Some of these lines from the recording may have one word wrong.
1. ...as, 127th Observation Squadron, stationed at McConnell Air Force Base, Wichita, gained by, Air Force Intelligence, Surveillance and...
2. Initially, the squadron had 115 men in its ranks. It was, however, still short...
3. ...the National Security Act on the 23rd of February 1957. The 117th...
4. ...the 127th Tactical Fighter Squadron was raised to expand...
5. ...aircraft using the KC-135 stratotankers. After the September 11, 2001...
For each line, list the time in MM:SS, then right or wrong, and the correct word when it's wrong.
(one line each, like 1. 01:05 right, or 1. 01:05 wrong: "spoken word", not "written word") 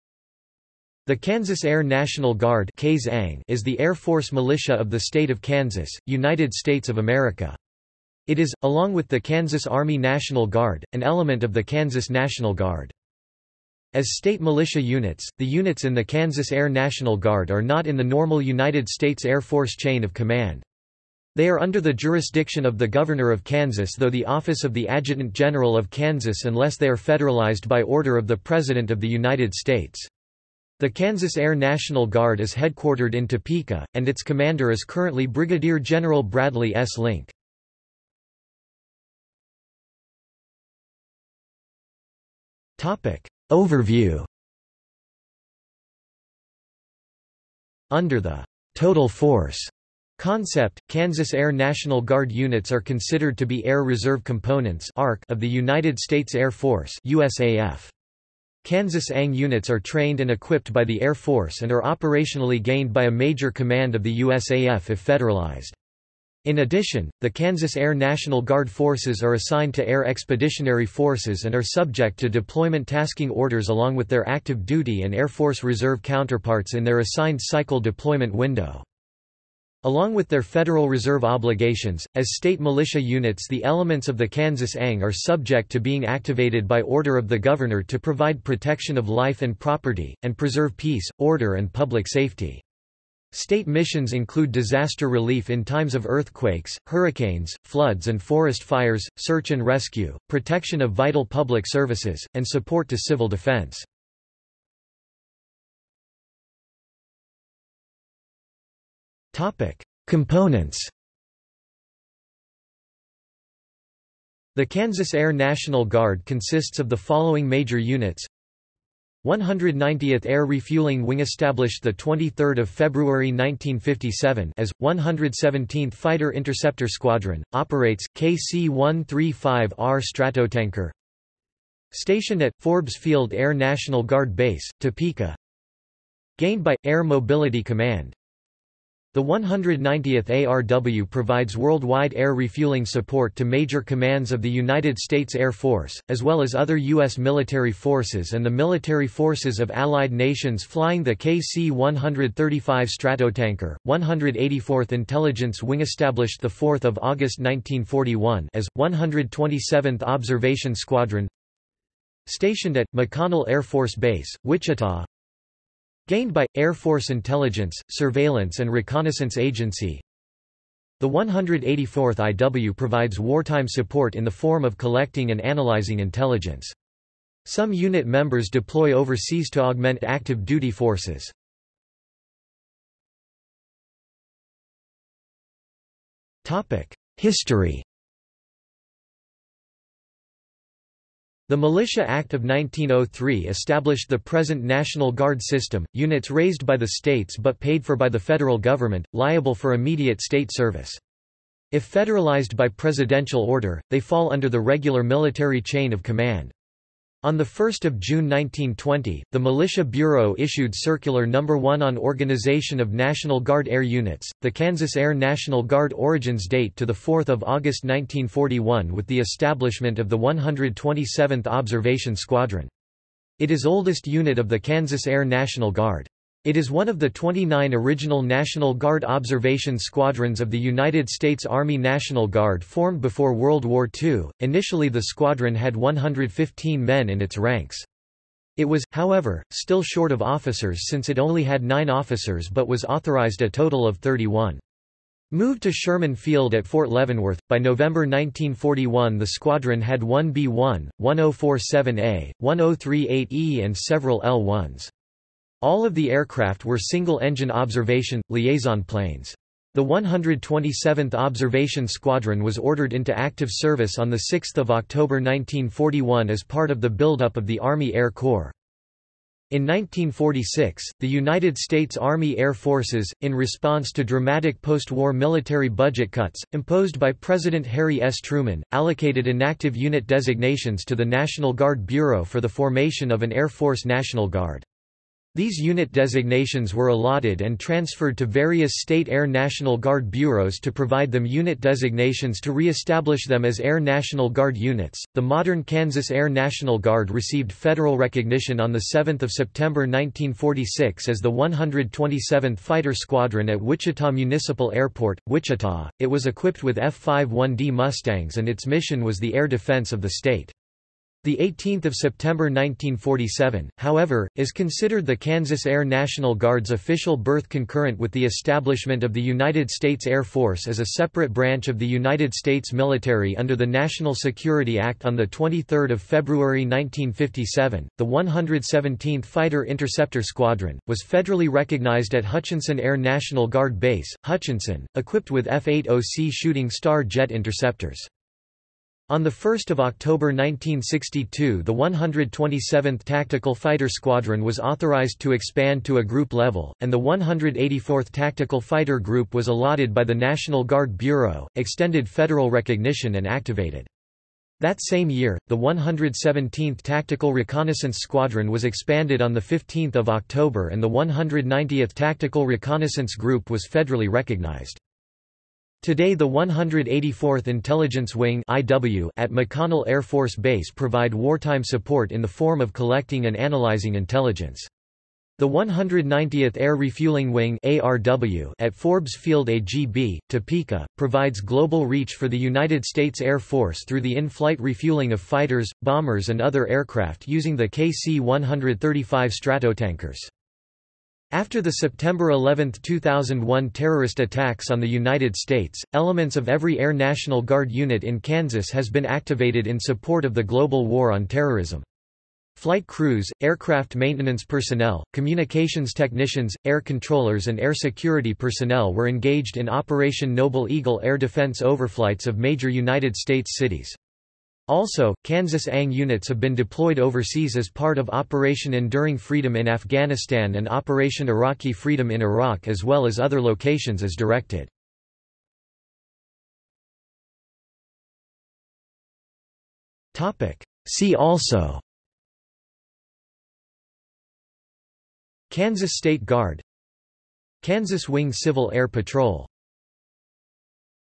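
1. 02:38 right
2. 03:54 right
3. 05:23 right
4. 05:41 wrong: "authorized", not "raised"
5. 06:26 right.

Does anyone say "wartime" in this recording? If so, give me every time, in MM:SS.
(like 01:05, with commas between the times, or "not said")
02:53, 06:11.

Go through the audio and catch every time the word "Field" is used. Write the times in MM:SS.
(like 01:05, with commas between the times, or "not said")
02:12, 04:06, 06:19.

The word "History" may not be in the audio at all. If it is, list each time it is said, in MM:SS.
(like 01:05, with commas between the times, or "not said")
03:07.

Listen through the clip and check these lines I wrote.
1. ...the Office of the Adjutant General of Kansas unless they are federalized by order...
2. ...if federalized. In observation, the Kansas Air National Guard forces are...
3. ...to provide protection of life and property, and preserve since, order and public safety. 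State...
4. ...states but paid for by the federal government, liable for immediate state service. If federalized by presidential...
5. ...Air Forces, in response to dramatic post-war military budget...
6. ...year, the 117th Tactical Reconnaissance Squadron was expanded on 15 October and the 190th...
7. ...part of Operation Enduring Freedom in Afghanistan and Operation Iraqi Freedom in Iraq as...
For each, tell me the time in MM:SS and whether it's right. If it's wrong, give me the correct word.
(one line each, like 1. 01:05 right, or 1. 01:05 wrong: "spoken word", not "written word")
1. 00:24 right
2. 01:04 wrong: "addition", not "observation"
3. 01:27 wrong: "peace", not "since"
4. 03:16 right
5. 04:32 right
6. 05:55 right
7. 06:57 right.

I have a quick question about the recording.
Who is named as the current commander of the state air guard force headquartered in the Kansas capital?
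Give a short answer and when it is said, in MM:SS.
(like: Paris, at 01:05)
Bradley S. Link, at 00:35.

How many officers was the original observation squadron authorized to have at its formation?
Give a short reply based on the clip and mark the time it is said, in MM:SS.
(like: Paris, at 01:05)
31, at 04:03.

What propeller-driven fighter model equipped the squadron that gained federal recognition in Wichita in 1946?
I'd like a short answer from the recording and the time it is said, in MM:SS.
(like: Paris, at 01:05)
F-51D Mustang, at 05:06.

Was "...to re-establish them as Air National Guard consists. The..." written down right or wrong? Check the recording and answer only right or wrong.
wrong.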